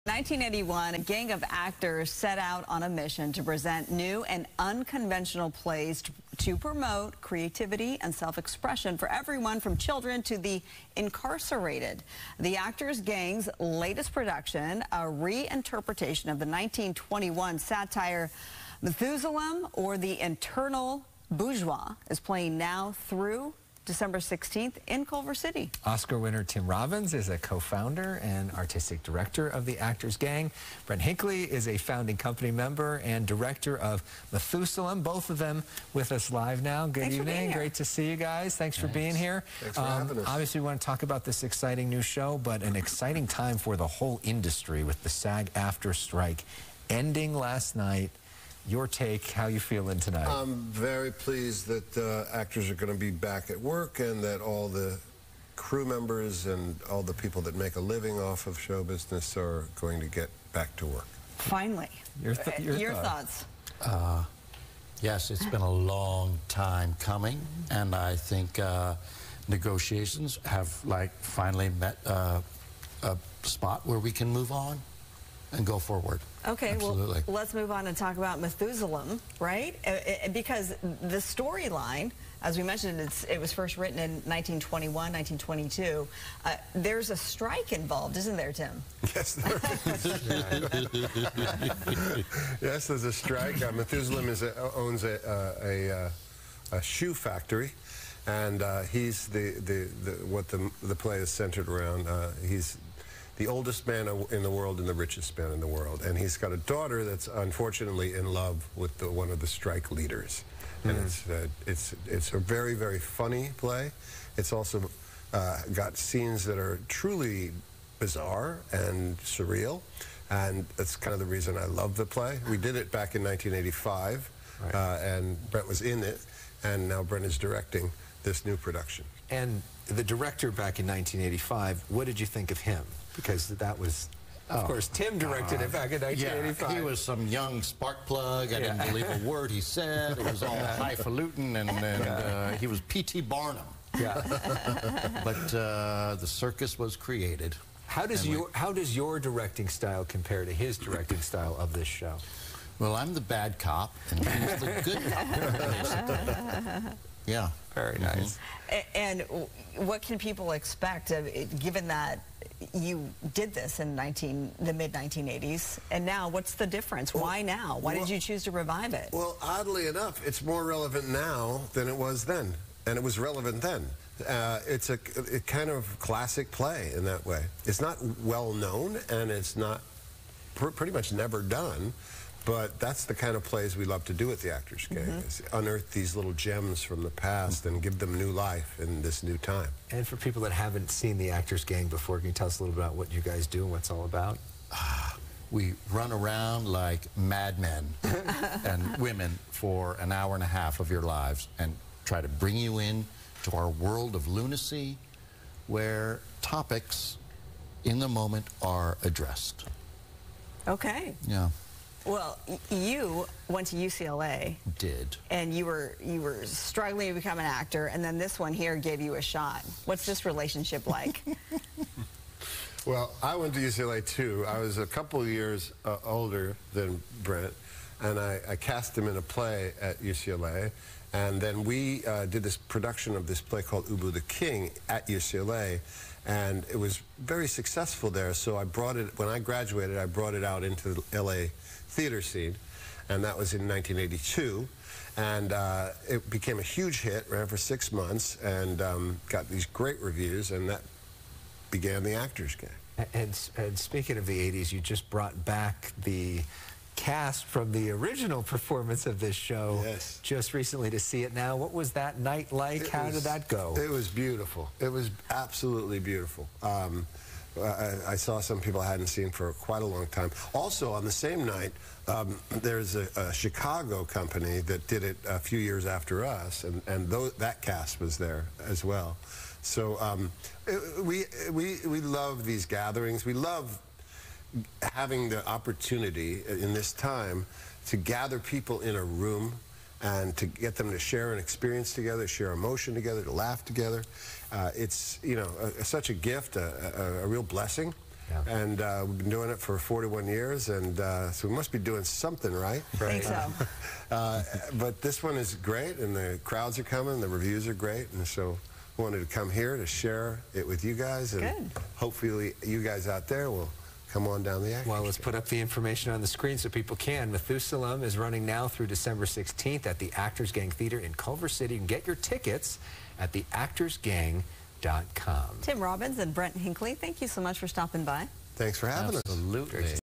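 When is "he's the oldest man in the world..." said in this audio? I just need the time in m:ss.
1:42.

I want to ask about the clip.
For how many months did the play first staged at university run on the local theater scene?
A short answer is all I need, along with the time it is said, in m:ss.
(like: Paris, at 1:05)
6, at 4:07.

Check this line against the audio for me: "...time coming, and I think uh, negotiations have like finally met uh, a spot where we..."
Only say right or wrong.
right.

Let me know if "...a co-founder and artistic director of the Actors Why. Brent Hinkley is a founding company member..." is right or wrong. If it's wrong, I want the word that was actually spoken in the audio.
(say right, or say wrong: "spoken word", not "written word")
wrong: "Gang", not "Why".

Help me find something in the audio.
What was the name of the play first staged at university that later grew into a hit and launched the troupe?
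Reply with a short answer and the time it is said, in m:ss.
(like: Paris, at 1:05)
Ubu the King, at 3:53.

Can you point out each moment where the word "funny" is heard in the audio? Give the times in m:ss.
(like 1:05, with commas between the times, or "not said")
1:52.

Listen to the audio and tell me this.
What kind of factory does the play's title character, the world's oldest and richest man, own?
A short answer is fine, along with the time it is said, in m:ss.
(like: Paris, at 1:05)
shoe factory, at 1:36.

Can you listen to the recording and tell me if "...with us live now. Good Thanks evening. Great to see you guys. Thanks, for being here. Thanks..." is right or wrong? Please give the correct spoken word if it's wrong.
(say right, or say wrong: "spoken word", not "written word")
right.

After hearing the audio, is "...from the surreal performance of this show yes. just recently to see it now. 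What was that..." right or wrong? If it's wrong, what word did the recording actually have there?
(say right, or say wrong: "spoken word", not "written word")
wrong: "original", not "surreal".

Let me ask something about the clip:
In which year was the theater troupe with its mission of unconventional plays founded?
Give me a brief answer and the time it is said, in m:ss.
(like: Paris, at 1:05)
1981, at 0:00.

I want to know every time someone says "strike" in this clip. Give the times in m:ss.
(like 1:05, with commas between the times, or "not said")
0:45, 1:27, 1:33, 1:49.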